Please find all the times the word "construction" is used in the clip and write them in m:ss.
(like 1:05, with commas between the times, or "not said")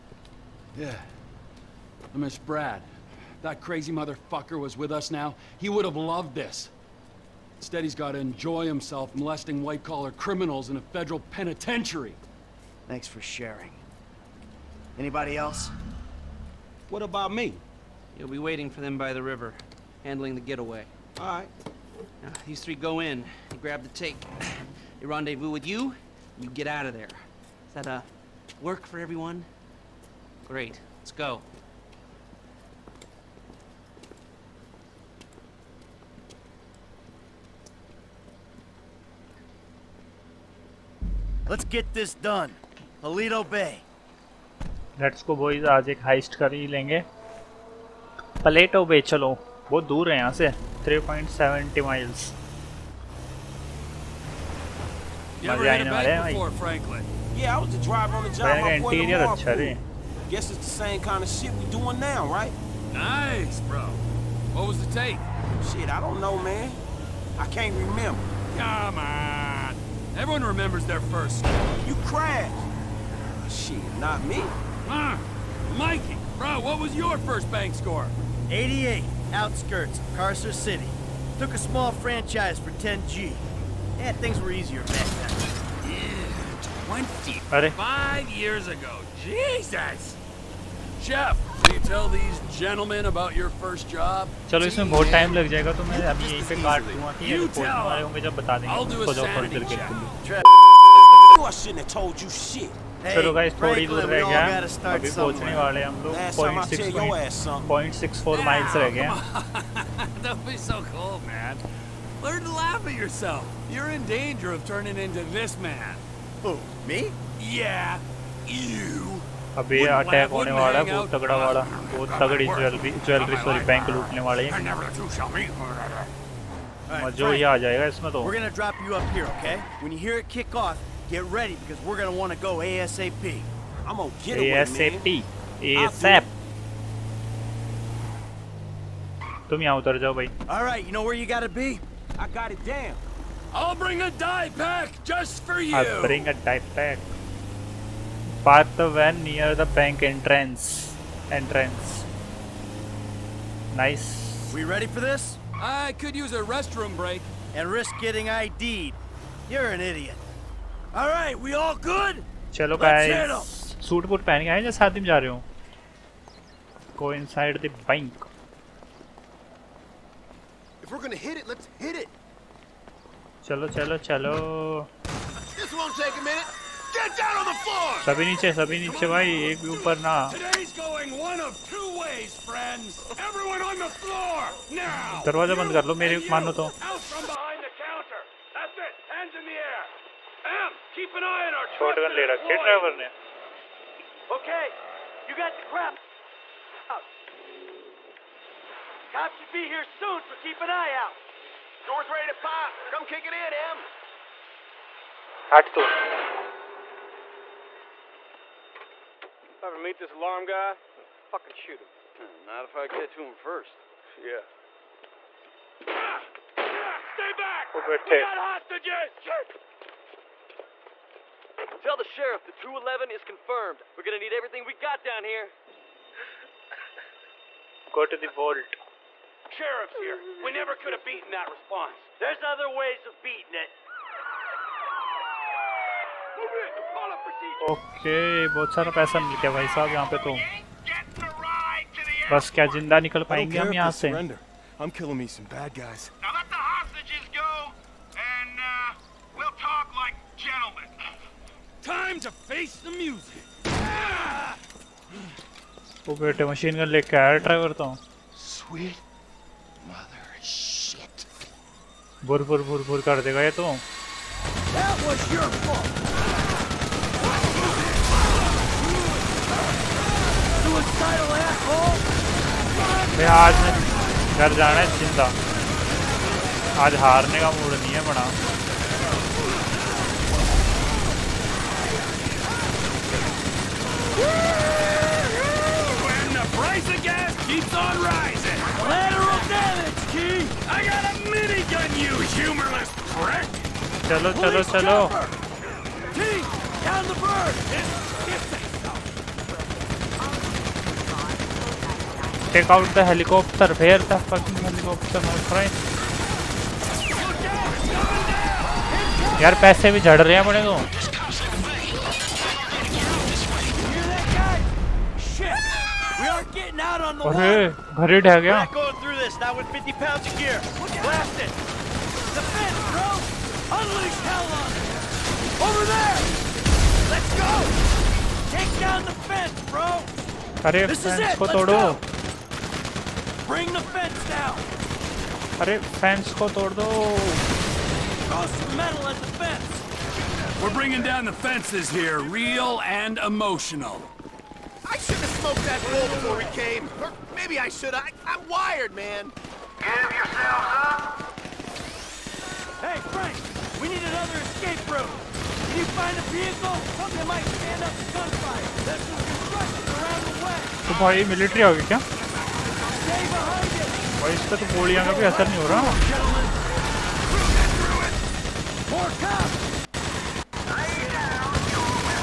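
5:59.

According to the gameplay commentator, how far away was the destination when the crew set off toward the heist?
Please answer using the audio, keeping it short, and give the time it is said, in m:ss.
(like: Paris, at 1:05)
3.70 miles, at 0:50.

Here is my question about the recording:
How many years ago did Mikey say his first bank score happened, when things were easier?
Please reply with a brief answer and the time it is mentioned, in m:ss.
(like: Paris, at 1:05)
25 years, at 1:26.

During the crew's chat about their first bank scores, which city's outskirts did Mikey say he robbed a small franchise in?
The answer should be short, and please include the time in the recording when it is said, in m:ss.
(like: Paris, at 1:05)
Carcer City, at 1:20.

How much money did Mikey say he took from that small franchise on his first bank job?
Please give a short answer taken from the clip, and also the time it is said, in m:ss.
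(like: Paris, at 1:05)
10G, at 1:22.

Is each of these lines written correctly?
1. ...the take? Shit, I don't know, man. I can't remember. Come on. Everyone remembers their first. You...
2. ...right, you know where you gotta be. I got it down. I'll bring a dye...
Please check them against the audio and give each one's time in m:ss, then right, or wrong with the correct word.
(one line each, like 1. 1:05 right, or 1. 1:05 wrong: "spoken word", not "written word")
1. 1:04 right
2. 2:20 right.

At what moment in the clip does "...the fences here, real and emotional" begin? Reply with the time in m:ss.
5:41.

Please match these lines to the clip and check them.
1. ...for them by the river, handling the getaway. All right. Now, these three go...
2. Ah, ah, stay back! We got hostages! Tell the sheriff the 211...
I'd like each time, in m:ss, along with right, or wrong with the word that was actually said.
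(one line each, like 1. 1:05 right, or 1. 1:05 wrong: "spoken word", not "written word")
1. 0:18 right
2. 3:36 right.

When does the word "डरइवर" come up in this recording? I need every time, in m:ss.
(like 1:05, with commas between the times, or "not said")
3:12, 4:17.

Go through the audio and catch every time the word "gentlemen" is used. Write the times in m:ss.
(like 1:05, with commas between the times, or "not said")
1:32.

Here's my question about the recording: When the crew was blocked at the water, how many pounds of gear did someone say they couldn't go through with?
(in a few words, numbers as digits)
50.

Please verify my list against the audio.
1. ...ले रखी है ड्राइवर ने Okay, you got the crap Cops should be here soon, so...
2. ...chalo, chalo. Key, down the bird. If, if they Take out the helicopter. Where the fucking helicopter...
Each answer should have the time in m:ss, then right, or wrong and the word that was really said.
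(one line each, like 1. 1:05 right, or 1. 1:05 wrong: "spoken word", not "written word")
1. 3:12 right
2. 4:54 right.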